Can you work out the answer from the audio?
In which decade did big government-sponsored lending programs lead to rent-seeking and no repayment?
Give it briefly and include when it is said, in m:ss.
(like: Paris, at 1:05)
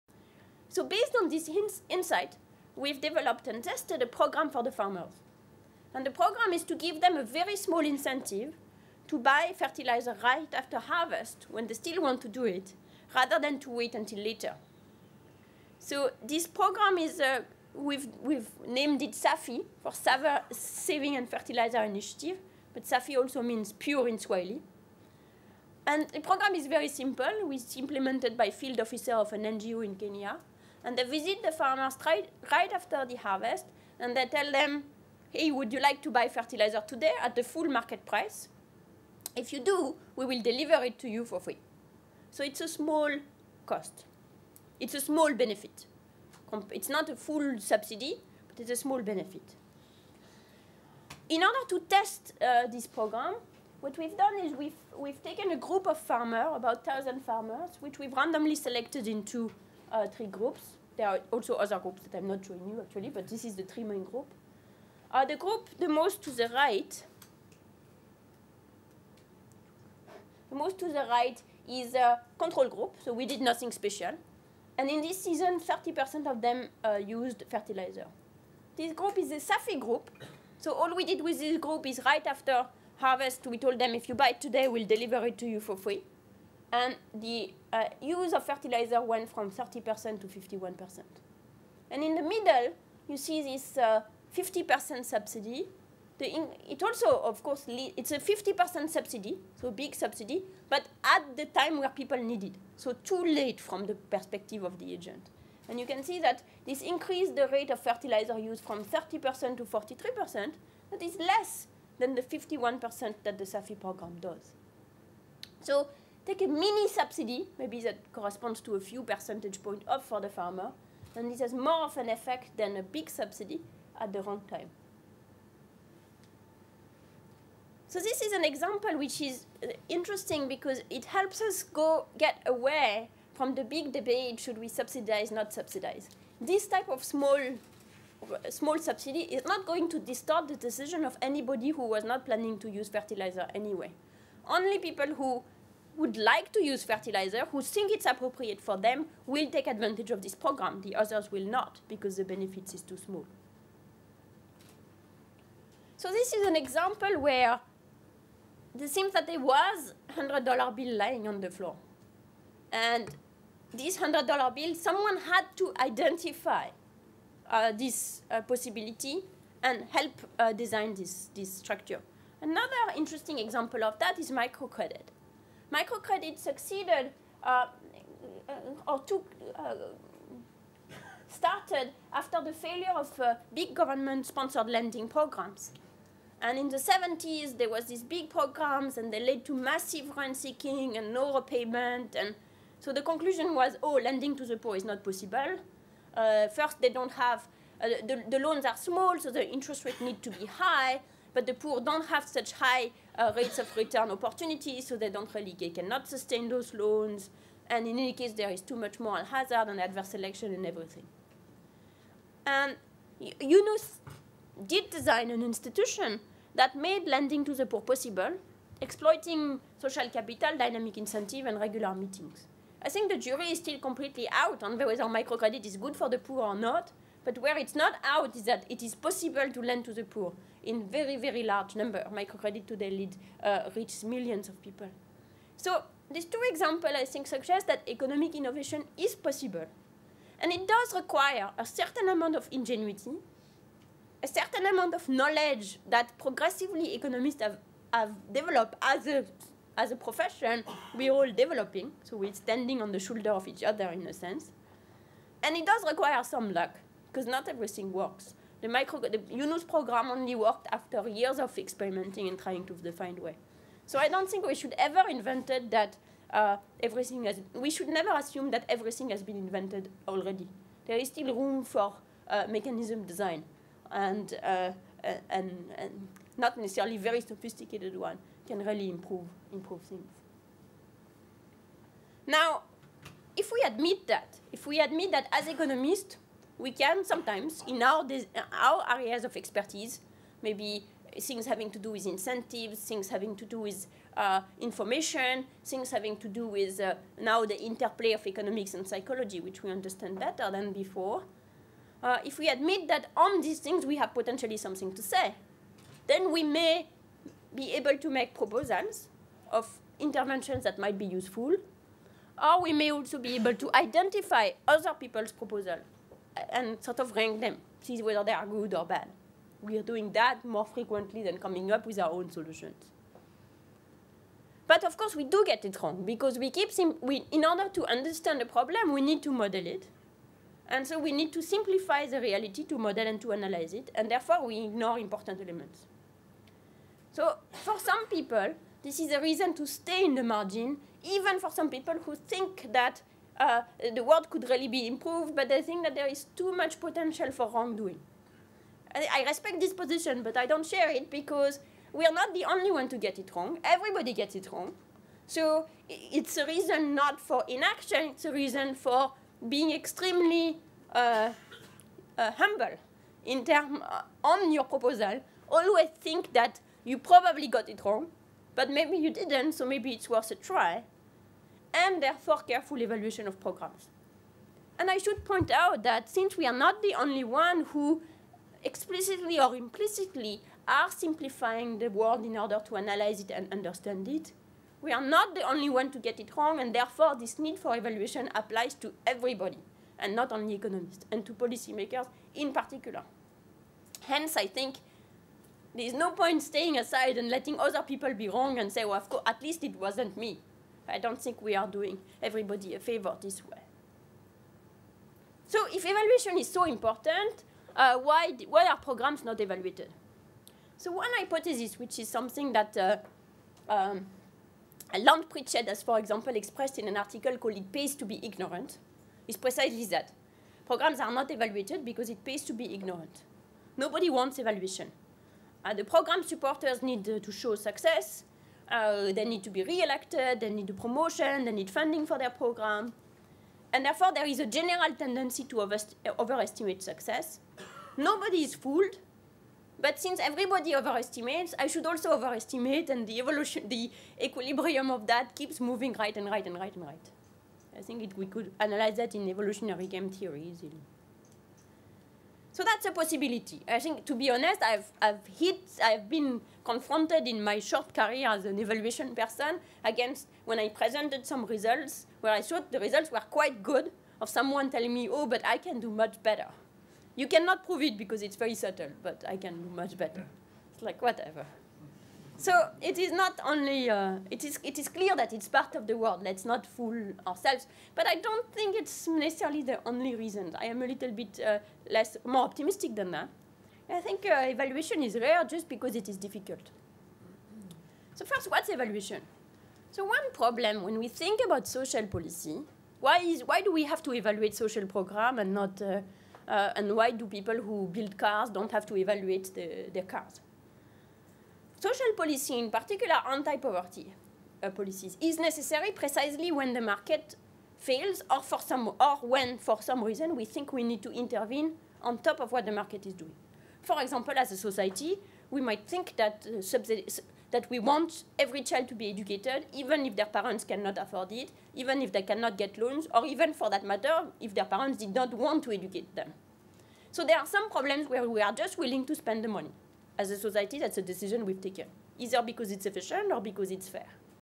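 the 70s, at 3:06.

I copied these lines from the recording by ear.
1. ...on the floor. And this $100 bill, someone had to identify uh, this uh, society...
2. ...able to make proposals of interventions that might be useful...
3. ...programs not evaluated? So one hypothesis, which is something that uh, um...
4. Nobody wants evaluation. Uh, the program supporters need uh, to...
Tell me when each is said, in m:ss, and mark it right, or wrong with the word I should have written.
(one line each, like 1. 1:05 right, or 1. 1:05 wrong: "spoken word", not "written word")
1. 2:41 wrong: "possibility", not "society"
2. 5:07 right
3. 6:48 right
4. 7:03 right.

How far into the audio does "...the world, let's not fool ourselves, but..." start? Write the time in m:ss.
7:55.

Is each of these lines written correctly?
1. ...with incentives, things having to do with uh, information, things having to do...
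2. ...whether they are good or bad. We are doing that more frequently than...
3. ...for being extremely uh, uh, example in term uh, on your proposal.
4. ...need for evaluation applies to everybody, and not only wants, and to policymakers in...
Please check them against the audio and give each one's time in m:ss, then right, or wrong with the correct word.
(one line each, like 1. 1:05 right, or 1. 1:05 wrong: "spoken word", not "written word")
1. 4:51 right
2. 5:18 right
3. 5:58 wrong: "humble", not "example"
4. 6:27 wrong: "economists", not "wants".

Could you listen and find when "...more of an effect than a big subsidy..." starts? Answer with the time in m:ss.
2:01.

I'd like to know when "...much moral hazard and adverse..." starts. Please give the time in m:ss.
3:28.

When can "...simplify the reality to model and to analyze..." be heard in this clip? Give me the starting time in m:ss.
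5:31.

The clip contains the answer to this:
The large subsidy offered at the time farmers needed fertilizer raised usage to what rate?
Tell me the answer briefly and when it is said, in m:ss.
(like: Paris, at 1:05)
43%, at 1:49.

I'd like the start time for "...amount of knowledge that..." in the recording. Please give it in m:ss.
4:04.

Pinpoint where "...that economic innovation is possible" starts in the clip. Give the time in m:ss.
3:57.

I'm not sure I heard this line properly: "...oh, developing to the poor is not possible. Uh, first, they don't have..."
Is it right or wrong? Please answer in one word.
wrong.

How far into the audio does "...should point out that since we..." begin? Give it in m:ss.
6:14.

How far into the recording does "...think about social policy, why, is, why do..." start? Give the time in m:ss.
8:11.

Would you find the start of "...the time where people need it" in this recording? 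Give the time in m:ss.
1:41.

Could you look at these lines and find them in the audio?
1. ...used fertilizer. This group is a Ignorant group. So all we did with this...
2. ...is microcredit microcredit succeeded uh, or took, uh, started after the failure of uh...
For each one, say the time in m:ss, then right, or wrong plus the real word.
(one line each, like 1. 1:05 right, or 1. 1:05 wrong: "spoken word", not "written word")
1. 1:16 wrong: "SAFI", not "Ignorant"
2. 2:54 right.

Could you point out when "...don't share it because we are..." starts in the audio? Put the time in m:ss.
5:50.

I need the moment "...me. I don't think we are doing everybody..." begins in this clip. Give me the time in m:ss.
6:40.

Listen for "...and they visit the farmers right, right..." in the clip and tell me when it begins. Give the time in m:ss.
0:30.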